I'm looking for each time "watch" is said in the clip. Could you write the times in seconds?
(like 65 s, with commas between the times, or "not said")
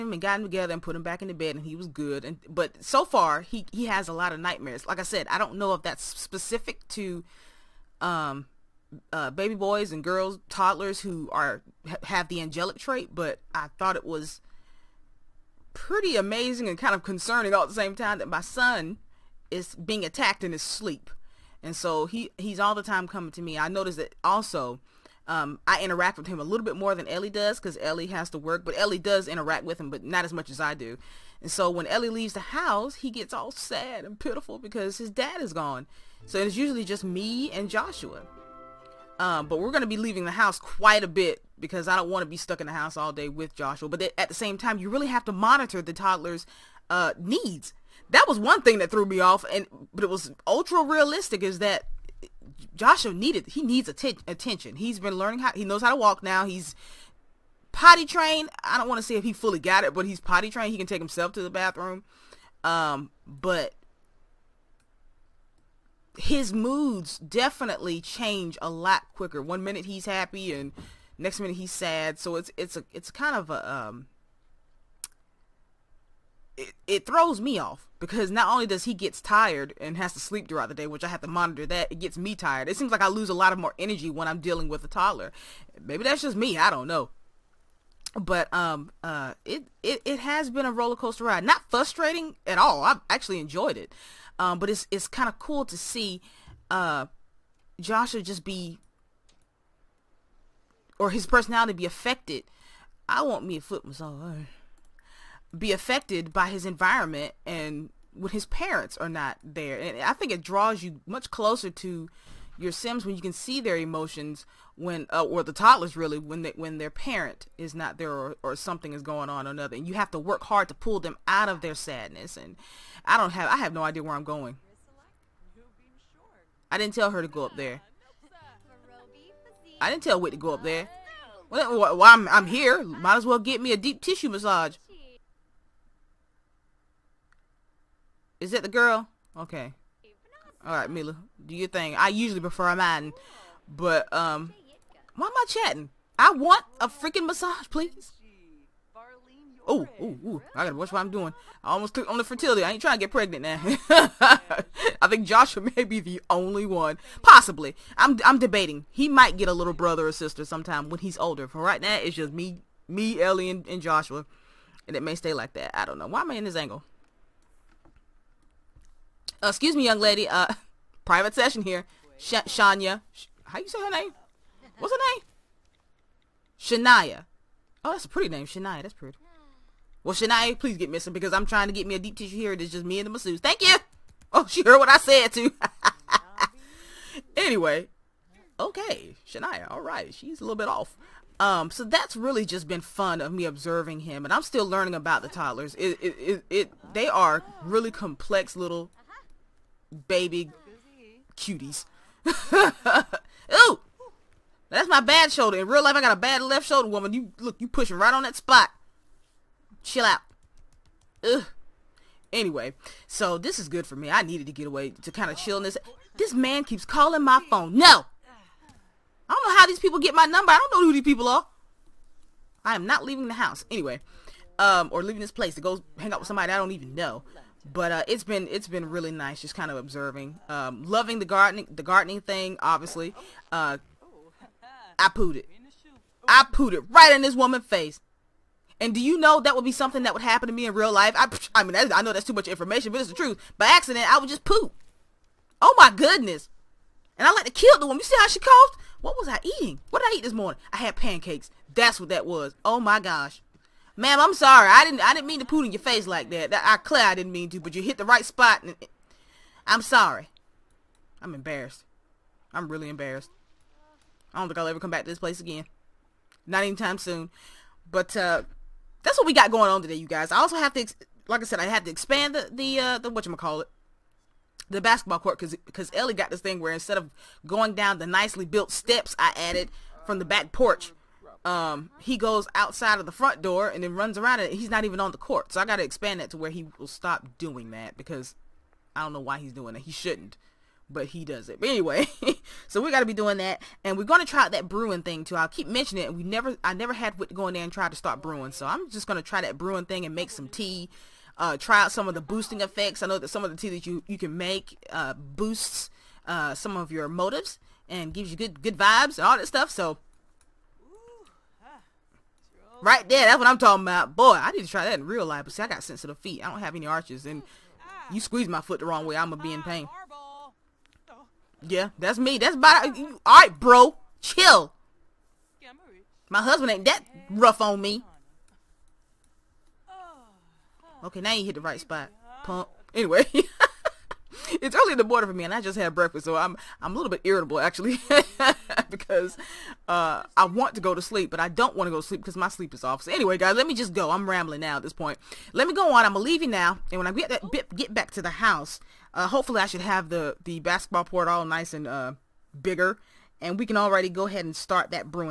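150 s.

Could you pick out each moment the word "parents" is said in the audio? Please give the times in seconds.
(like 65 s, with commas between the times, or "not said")
108 s, 116 s.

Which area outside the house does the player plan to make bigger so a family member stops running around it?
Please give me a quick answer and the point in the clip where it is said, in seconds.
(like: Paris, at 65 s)
Basketball court, at 274 s.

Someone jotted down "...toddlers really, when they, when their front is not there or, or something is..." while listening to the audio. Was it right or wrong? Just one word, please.
wrong.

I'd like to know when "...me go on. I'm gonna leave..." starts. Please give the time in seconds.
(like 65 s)
345 s.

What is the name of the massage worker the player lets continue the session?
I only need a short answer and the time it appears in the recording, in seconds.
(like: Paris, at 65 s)
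Mila, at 140 s.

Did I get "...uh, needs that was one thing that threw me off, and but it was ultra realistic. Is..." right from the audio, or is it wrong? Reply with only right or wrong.
right.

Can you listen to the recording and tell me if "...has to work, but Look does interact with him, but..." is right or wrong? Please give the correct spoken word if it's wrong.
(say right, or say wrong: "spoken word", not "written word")
wrong: "Ellie", not "Look".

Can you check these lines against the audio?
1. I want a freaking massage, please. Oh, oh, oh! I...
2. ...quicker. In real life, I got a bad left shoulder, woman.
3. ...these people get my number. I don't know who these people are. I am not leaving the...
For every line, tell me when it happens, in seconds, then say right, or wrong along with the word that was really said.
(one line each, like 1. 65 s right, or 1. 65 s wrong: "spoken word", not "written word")
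1. 146 s right
2. 205 s wrong: "shoulder", not "quicker"
3. 219 s right.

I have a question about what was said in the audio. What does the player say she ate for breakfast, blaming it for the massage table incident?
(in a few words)
Pancakes.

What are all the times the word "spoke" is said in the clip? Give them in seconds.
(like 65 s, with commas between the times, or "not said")
not said.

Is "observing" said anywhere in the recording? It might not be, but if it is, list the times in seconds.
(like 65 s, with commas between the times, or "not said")
193 s, 229 s.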